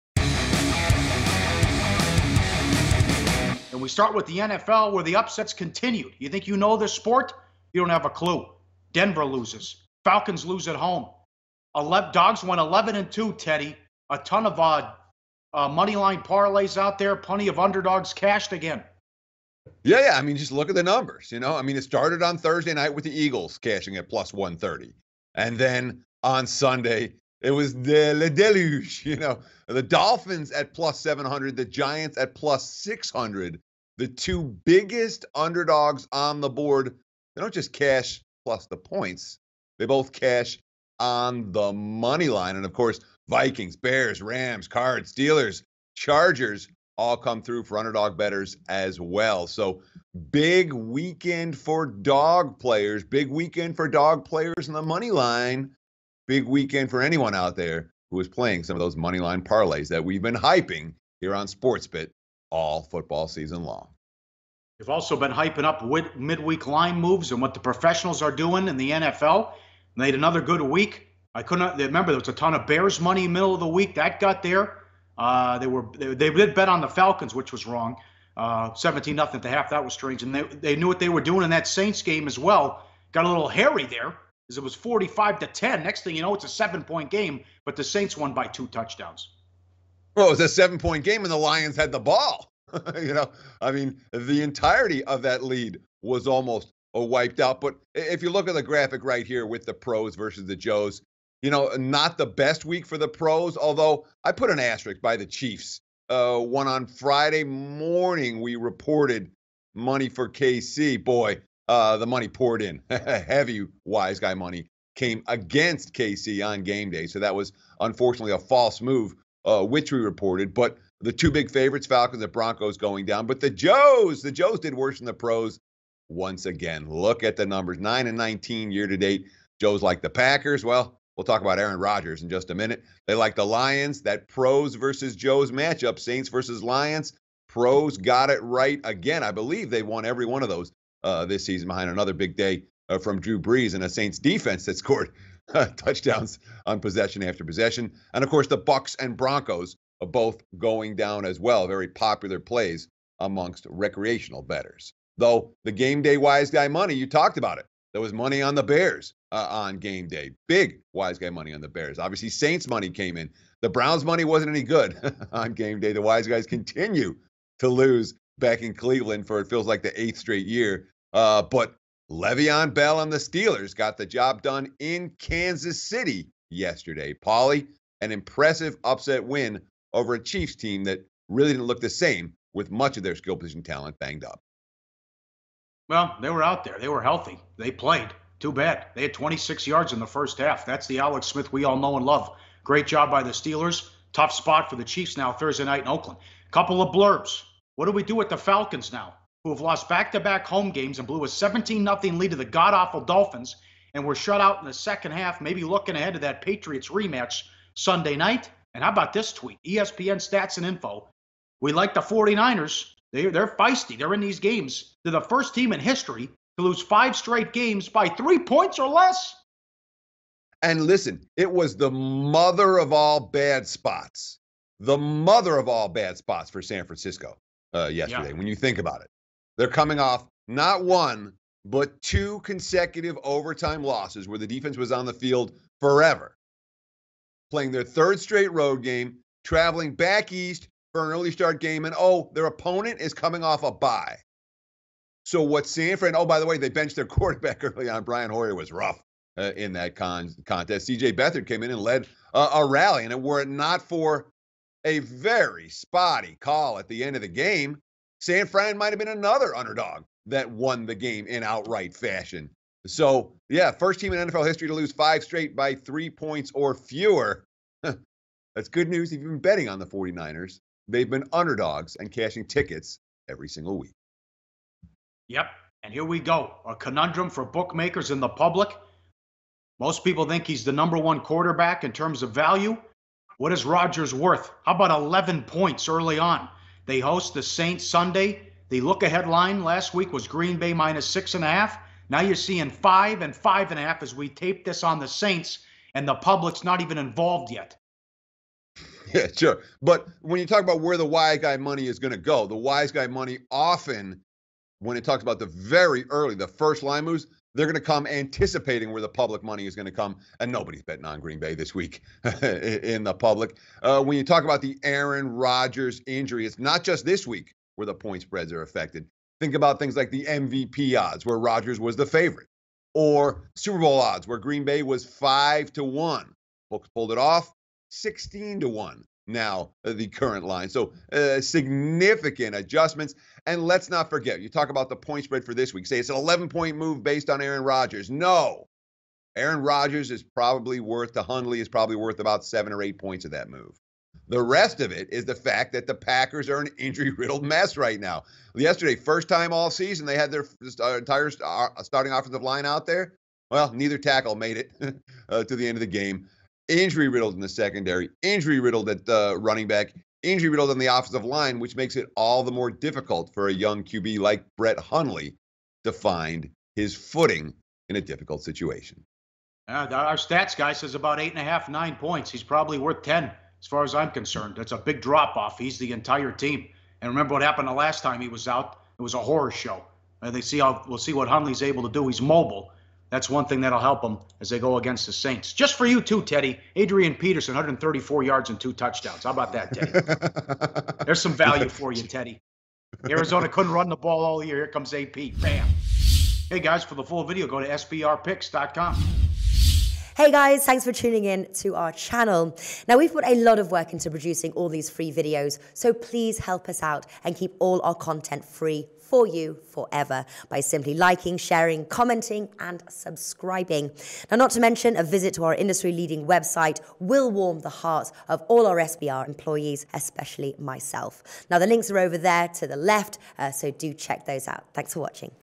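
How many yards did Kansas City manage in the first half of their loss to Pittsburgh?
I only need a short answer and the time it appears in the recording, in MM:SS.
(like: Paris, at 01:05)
26, at 03:09.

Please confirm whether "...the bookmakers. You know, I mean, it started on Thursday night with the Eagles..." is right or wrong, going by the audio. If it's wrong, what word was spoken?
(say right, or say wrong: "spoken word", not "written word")
wrong: "numbers", not "bookmakers".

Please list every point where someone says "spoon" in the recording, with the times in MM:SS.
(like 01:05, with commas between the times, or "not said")
not said.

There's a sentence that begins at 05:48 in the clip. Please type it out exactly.
Yesterday, first time all season, they had their uh, entire uh, starting offensive line out there.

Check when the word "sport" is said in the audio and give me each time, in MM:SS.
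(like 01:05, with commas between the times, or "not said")
00:06, 01:01.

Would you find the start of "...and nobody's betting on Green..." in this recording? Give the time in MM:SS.
05:10.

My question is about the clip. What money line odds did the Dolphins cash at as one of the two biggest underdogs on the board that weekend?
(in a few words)
+700.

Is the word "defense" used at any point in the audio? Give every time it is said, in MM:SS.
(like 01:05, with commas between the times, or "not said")
02:24, 03:54.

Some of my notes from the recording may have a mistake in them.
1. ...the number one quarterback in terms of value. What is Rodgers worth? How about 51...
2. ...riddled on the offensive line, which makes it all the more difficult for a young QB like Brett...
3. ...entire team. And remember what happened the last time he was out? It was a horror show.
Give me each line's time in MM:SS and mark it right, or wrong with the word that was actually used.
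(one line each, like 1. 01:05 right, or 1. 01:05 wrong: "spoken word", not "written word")
1. 04:40 wrong: "11", not "51"
2. 06:00 right
3. 06:15 right.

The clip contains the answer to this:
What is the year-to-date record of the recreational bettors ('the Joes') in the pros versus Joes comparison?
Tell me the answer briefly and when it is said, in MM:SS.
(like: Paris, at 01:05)
9 and 19, at 02:07.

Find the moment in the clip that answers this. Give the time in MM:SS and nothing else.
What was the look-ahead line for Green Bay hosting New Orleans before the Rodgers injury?
04:50.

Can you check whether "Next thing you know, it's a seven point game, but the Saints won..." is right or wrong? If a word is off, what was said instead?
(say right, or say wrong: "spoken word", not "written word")
right.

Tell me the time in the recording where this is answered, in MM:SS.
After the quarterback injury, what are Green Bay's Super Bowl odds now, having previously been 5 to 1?
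05:27.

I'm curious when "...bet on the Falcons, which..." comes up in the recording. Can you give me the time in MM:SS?
01:16.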